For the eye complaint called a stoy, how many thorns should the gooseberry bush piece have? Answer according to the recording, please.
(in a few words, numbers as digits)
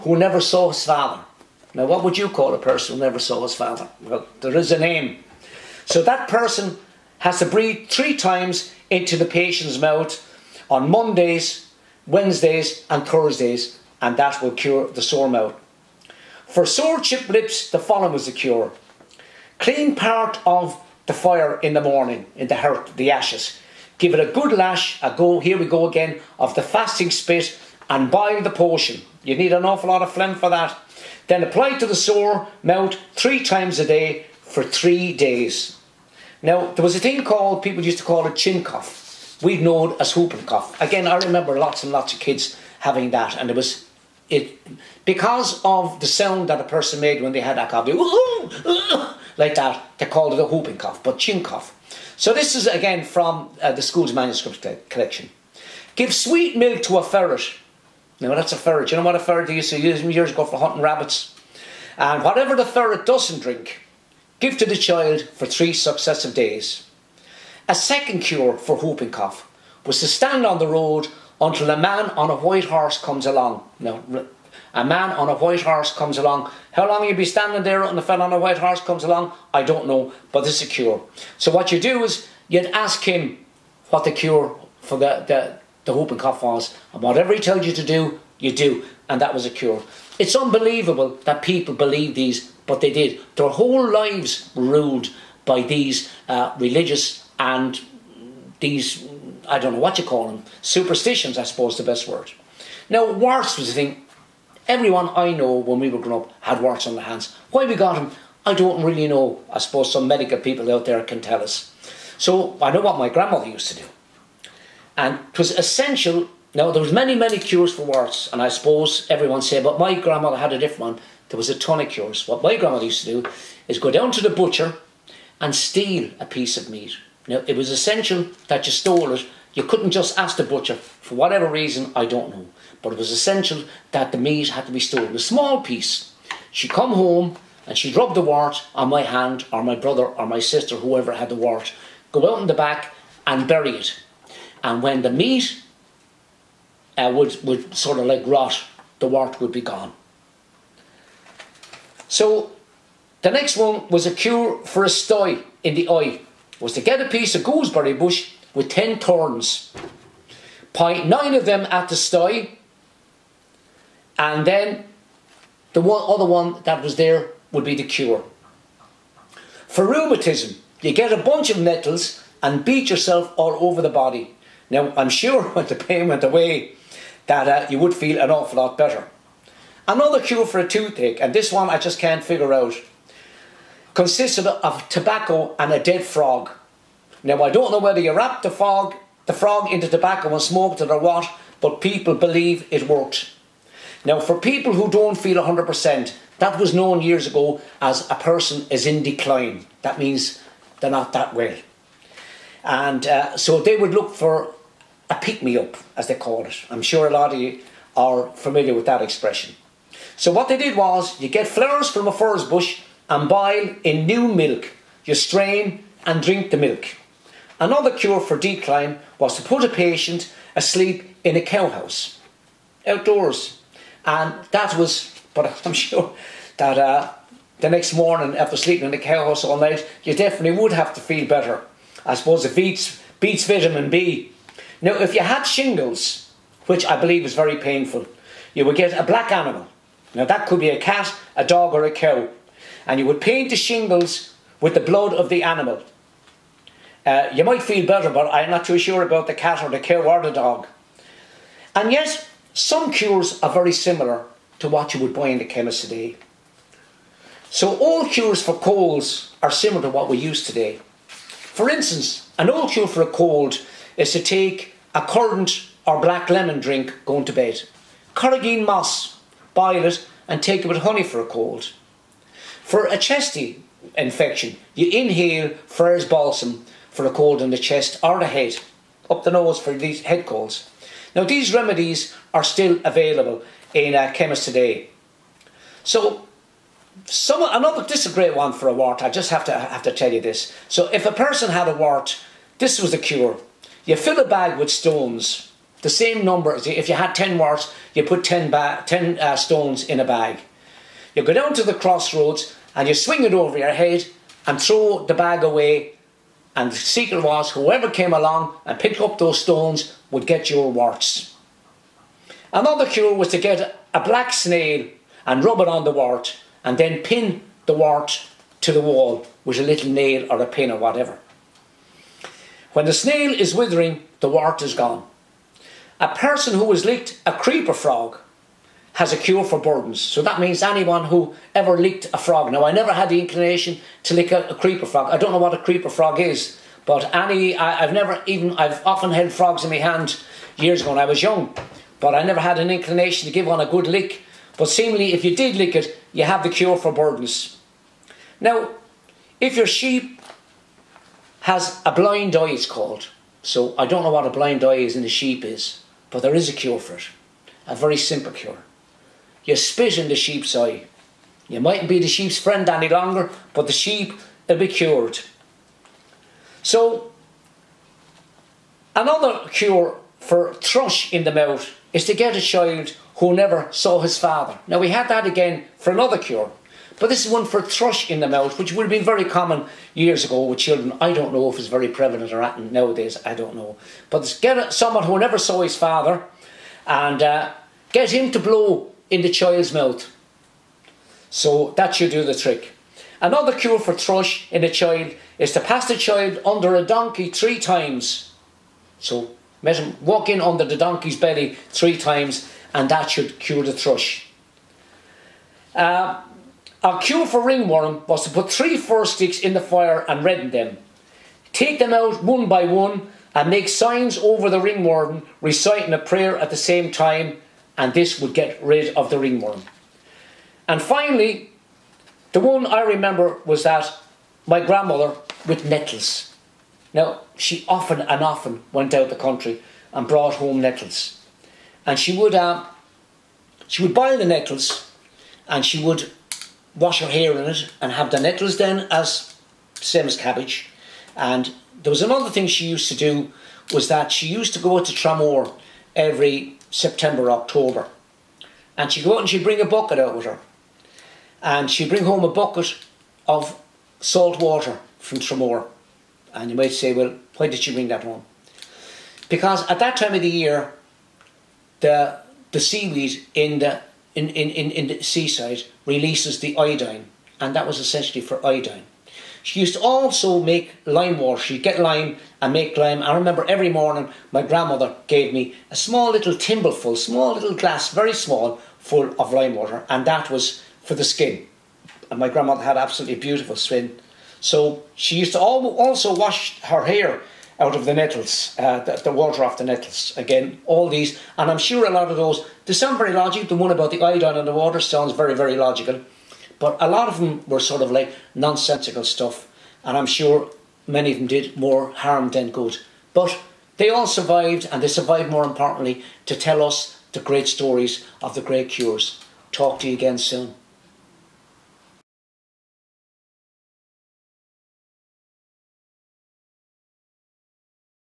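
10.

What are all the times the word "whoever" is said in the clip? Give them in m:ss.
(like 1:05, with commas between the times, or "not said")
2:20, 5:07.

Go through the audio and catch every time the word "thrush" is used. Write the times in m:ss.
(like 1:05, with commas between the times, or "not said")
6:10, 6:17, 6:33, 6:43.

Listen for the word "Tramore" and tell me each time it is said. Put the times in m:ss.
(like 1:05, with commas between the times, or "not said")
7:24, 7:35.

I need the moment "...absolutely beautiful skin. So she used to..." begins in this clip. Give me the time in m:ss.
8:02.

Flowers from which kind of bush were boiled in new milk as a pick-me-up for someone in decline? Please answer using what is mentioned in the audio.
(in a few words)
Furze.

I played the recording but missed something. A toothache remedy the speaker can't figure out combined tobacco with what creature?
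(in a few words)
A dead frog.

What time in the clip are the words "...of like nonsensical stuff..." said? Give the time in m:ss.
8:17.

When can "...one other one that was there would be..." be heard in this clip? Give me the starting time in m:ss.
2:45.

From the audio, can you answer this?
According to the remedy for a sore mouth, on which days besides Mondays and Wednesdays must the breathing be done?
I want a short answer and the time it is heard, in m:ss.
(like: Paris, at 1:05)
Thursdays, at 0:13.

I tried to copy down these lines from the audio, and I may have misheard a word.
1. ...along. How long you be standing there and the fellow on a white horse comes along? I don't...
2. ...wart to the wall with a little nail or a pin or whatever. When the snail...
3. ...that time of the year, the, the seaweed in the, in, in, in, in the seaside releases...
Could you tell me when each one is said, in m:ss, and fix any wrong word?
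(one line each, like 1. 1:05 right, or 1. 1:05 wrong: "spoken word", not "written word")
1. 1:16 right
2. 5:17 right
3. 7:39 right.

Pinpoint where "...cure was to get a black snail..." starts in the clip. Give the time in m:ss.
5:12.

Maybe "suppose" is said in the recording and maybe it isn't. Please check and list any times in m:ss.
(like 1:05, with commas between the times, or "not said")
1:41, 1:49, 1:58, 3:52.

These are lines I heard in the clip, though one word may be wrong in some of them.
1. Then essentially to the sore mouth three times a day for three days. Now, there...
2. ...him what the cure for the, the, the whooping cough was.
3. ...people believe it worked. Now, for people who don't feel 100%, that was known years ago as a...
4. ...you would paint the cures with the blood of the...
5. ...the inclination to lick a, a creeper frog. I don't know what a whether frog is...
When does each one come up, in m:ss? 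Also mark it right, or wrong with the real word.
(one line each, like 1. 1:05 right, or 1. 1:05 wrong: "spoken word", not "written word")
1. 0:31 wrong: "apply", not "essentially"
2. 1:23 right
3. 3:11 right
4. 4:02 wrong: "shingles", not "cures"
5. 5:33 wrong: "creeper", not "whether".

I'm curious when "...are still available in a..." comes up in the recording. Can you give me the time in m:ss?
4:42.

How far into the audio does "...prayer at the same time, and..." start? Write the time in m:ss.
6:55.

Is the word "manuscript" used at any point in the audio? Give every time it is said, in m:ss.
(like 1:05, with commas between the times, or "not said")
0:54.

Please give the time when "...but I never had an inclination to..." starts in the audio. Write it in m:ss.
5:41.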